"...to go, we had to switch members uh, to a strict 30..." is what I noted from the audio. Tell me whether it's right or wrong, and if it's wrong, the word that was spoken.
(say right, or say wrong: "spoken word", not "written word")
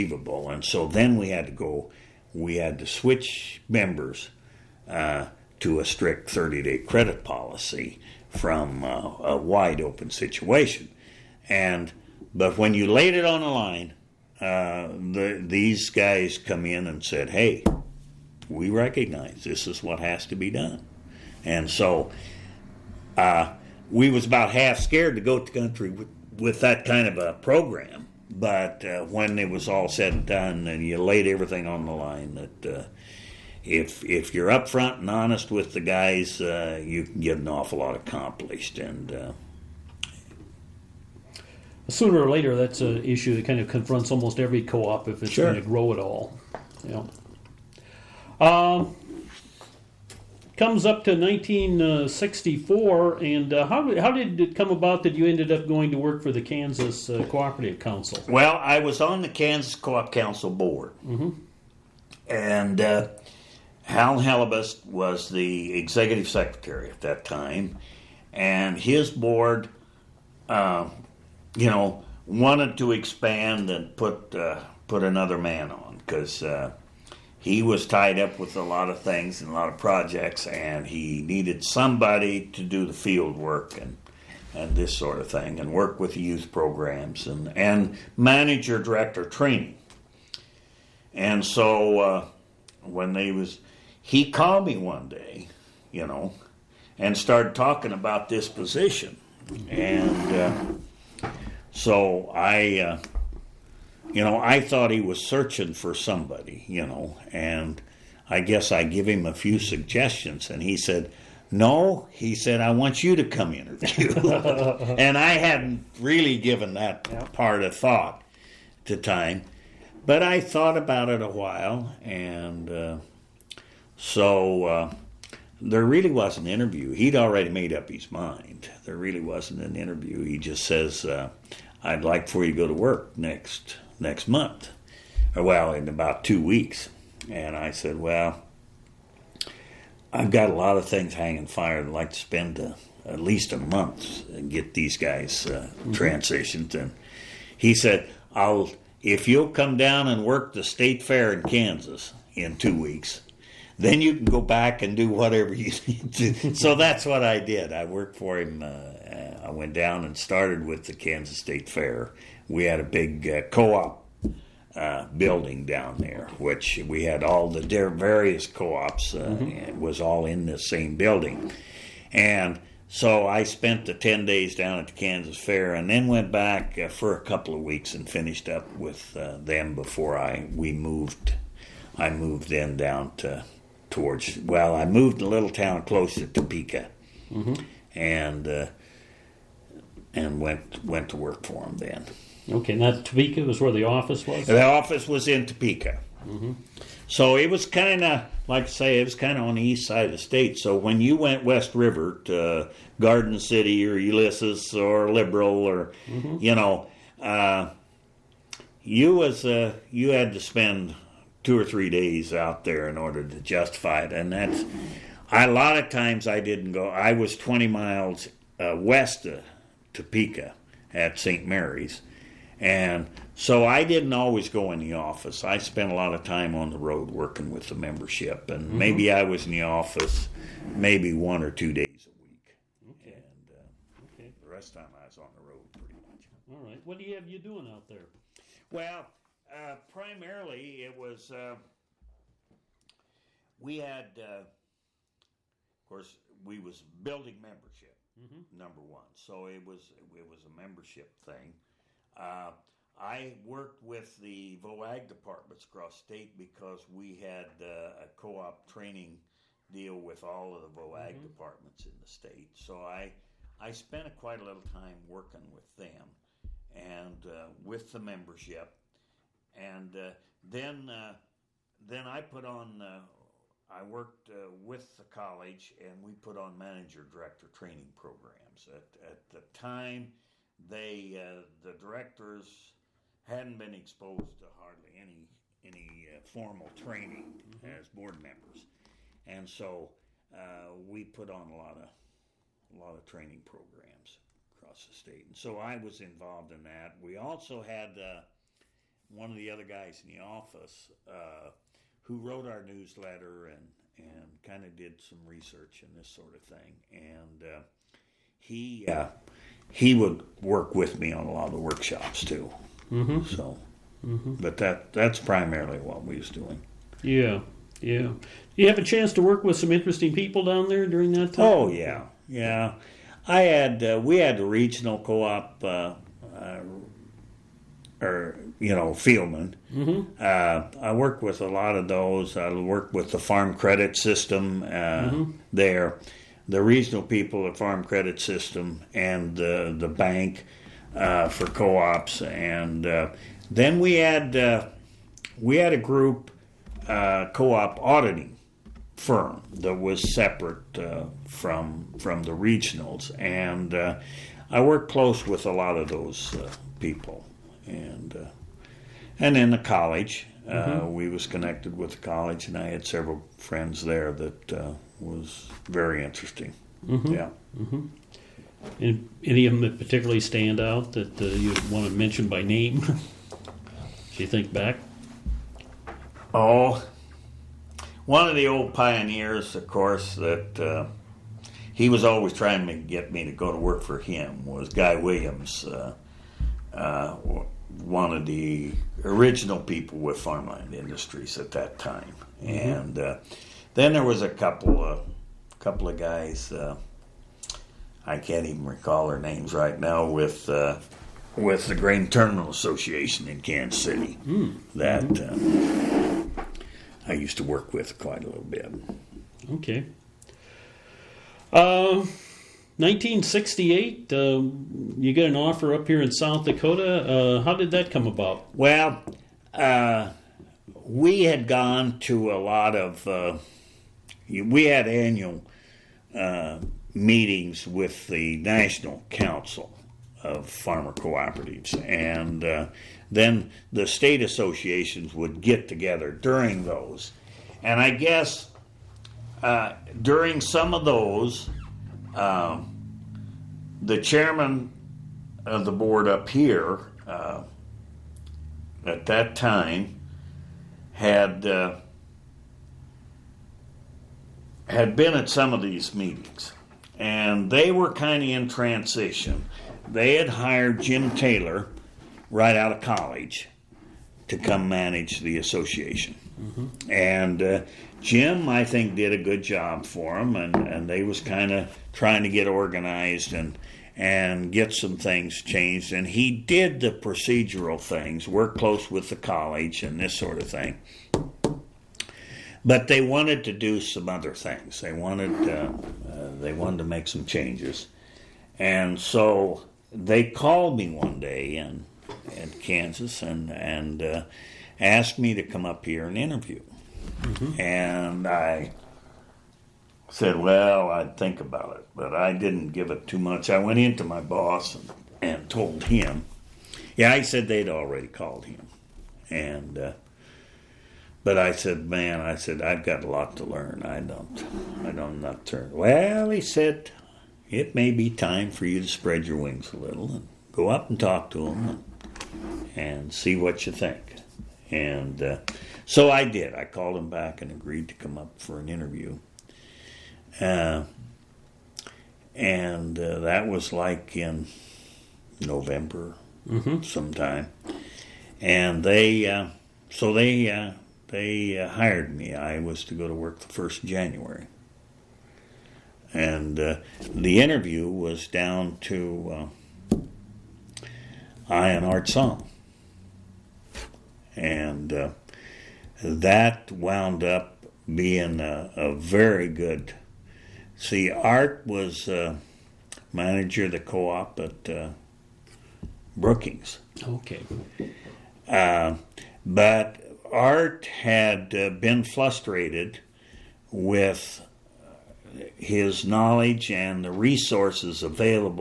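right.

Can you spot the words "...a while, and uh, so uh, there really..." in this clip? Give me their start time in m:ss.
2:01.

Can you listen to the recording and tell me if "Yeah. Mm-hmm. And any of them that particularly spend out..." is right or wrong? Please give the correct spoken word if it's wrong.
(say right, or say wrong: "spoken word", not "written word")
wrong: "stand", not "spend".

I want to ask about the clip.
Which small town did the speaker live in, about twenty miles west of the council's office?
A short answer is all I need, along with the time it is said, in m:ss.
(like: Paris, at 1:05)
St. Mary's, at 3:41.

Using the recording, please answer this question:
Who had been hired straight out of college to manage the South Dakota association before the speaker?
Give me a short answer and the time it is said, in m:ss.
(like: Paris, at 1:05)
Jim Taylor, at 7:40.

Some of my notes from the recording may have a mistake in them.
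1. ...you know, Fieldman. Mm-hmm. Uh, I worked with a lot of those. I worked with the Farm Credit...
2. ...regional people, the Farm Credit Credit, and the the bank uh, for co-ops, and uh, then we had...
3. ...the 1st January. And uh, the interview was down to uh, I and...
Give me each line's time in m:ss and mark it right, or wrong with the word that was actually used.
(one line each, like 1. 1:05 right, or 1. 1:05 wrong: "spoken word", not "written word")
1. 5:28 right
2. 5:36 wrong: "System", not "Credit"
3. 9:03 right.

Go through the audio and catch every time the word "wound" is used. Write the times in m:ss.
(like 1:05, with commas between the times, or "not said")
9:16.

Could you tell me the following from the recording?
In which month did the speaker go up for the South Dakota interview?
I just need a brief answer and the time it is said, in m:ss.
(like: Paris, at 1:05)
November, at 8:55.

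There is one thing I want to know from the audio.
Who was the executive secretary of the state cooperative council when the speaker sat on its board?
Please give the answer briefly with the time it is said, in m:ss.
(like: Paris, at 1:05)
Hal Halibus, at 1:03.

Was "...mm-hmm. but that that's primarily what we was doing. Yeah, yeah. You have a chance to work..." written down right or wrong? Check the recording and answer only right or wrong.
right.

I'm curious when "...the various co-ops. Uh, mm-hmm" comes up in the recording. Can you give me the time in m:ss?
2:47.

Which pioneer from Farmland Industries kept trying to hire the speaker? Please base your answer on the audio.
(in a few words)
Guy Williams.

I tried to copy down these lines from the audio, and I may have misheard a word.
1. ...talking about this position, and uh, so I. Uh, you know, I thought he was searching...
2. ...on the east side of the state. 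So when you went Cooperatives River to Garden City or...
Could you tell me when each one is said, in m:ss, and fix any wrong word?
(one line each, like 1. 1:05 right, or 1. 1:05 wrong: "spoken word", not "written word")
1. 1:37 right
2. 3:19 wrong: "West", not "Cooperatives".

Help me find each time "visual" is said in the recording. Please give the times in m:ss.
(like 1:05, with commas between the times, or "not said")
not said.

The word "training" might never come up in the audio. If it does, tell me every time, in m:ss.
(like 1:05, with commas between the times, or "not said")
1:29, 4:18, 4:37, 4:46, 4:53.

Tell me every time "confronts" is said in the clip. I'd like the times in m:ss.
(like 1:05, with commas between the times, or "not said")
0:43.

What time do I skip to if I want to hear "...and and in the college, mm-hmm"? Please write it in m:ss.
5:57.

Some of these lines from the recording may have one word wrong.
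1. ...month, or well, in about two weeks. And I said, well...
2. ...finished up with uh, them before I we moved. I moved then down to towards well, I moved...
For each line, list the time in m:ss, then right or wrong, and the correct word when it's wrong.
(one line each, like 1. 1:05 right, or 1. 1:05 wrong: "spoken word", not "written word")
1. 2:14 right
2. 2:58 right.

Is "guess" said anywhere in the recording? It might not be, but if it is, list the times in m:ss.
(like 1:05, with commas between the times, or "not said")
1:48, 7:17.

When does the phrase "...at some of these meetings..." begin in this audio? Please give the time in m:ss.
7:35.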